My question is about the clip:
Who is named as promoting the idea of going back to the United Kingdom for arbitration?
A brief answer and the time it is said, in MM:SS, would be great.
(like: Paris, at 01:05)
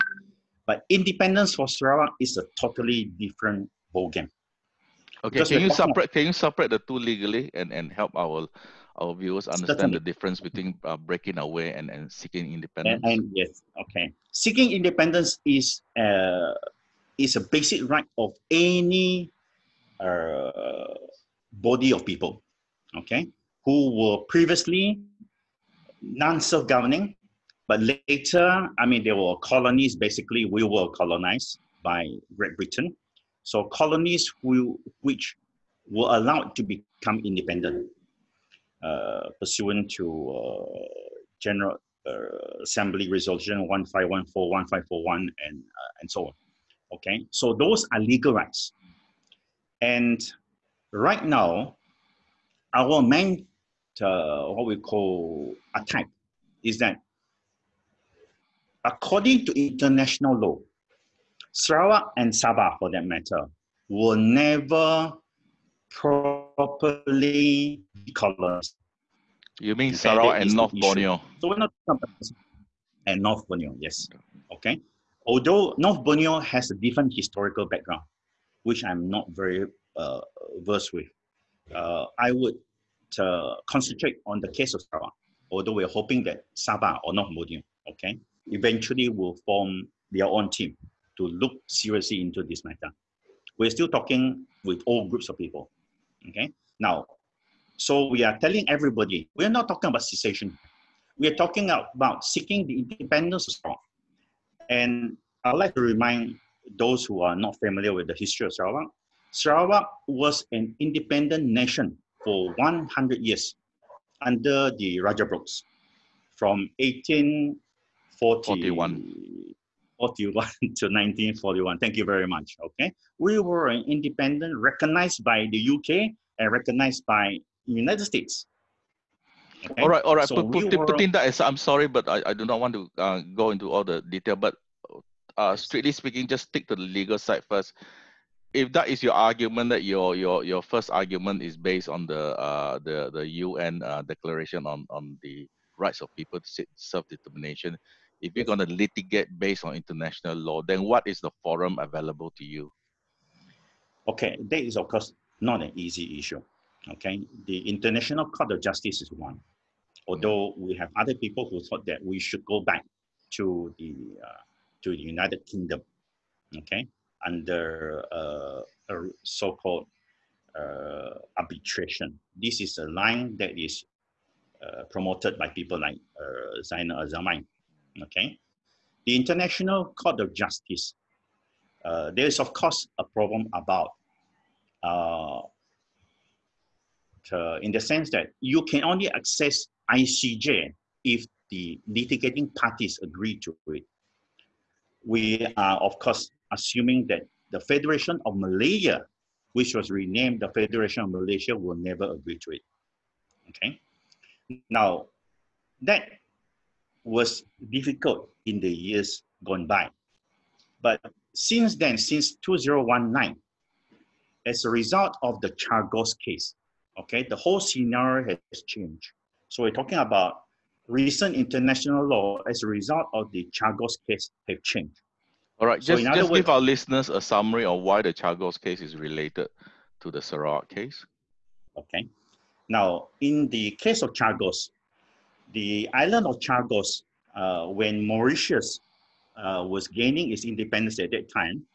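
Zainnal Ajamain, at 02:56.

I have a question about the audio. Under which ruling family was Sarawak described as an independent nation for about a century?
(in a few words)
Rajah Brookes.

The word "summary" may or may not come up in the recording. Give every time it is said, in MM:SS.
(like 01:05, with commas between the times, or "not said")
03:47.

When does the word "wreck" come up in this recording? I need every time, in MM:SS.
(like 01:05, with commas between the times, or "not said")
not said.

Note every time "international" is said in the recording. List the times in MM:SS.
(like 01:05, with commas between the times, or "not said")
00:59, 02:29, 02:37, 02:59, 03:41.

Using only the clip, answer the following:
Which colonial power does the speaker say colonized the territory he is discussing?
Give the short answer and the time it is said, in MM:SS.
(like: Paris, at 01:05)
Great Britain, at 00:32.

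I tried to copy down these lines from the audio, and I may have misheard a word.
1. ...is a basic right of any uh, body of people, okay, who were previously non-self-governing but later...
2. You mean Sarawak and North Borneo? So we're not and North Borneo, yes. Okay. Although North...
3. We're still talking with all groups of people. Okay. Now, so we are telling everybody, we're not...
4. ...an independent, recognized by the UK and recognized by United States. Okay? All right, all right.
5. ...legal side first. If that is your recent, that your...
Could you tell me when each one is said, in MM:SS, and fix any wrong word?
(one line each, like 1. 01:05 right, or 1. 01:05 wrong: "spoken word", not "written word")
1. 00:17 right
2. 01:09 right
3. 01:33 right
4. 02:03 right
5. 02:16 wrong: "argument", not "recent".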